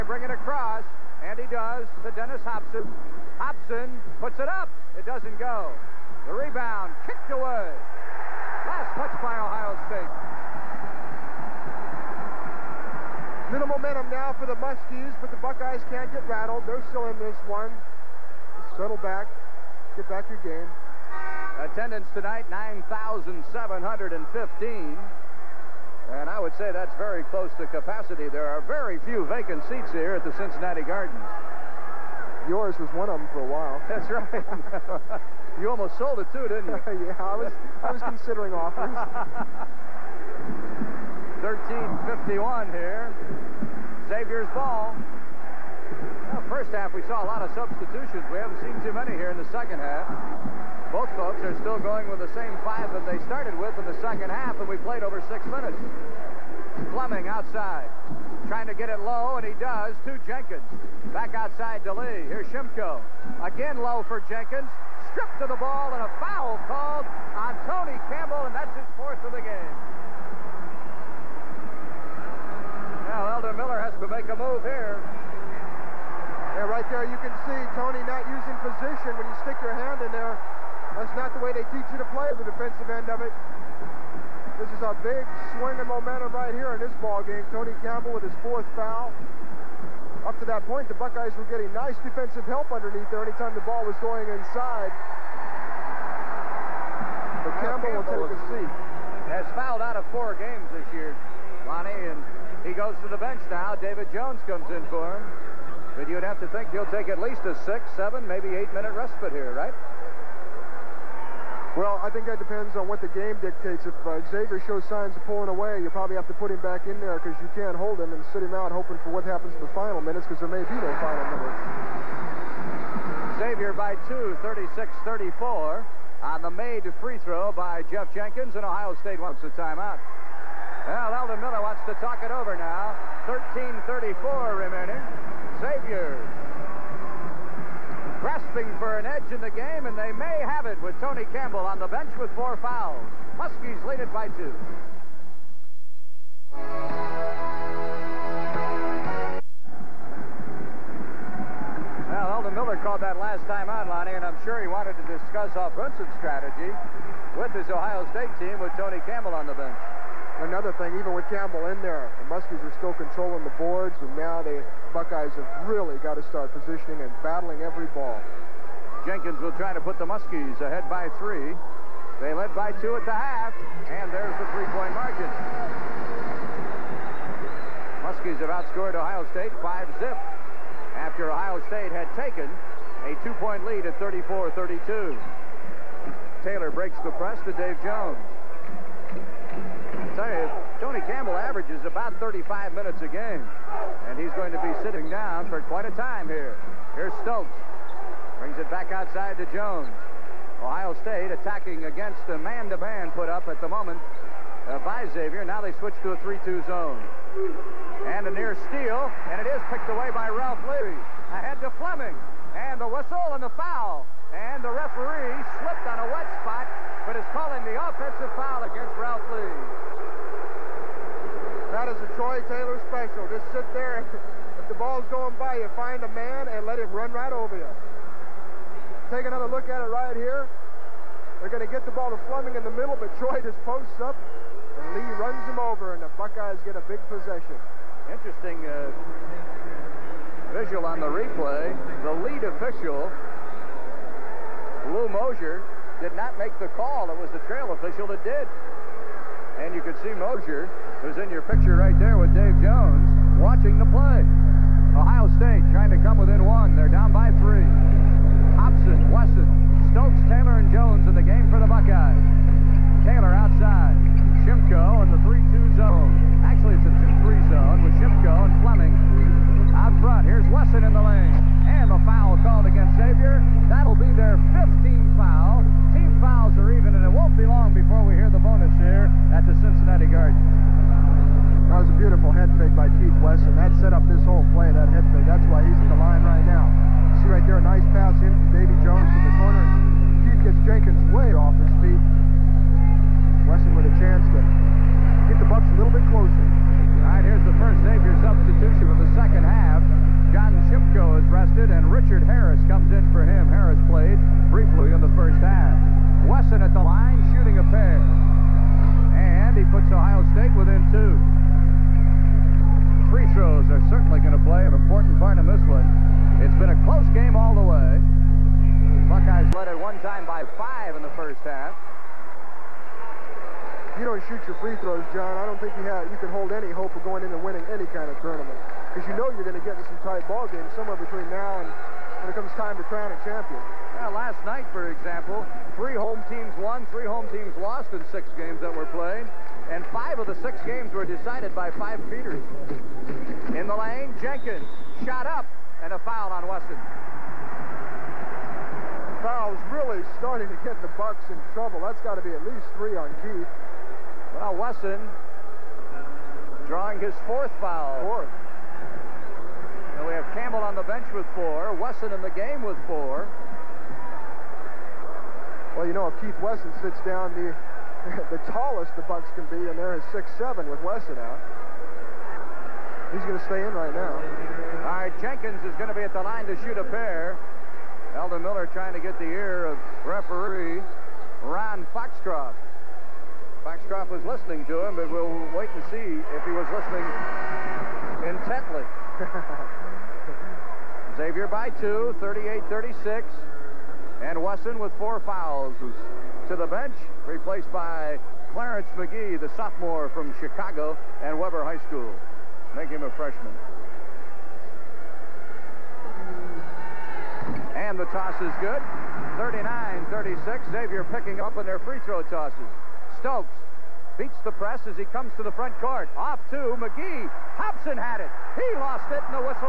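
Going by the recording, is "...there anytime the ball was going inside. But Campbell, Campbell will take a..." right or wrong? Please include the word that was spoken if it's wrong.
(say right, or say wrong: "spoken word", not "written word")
right.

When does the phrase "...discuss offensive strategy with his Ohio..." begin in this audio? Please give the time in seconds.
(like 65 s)
155 s.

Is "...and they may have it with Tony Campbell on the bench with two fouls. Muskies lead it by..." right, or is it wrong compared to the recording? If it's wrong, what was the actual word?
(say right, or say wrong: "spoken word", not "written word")
wrong: "four", not "two".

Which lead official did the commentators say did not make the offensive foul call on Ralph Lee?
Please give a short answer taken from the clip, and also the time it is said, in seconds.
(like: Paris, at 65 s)
Lou Mosier, at 244 s.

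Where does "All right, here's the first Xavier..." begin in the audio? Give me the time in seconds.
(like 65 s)
296 s.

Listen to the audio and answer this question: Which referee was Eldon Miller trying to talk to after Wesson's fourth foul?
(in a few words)
Ron Foxcroft.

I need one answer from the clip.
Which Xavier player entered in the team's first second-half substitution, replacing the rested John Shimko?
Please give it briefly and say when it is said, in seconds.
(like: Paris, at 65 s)
Richard Harris, at 301 s.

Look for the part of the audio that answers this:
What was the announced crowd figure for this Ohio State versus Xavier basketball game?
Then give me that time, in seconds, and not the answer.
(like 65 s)
22 s.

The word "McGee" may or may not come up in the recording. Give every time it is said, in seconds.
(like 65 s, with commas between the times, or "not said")
398 s, 416 s.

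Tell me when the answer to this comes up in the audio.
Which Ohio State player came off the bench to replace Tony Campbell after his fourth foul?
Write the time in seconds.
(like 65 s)
103 s.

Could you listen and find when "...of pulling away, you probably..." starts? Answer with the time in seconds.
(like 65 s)
115 s.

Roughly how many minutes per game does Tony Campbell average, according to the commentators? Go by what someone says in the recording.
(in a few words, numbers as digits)
35.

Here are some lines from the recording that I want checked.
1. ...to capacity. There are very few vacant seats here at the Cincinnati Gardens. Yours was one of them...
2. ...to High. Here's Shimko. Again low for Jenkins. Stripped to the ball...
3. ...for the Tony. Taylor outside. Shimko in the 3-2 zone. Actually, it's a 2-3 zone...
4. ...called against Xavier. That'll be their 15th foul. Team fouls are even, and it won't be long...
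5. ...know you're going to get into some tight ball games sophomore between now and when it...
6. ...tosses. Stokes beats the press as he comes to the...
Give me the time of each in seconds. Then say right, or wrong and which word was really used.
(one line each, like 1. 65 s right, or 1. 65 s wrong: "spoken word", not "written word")
1. 27 s right
2. 61 s wrong: "Lee", not "High"
3. 261 s wrong: "Buckeyes", not "Tony"
4. 272 s right
5. 329 s wrong: "somewhere", not "sophomore"
6. 412 s right.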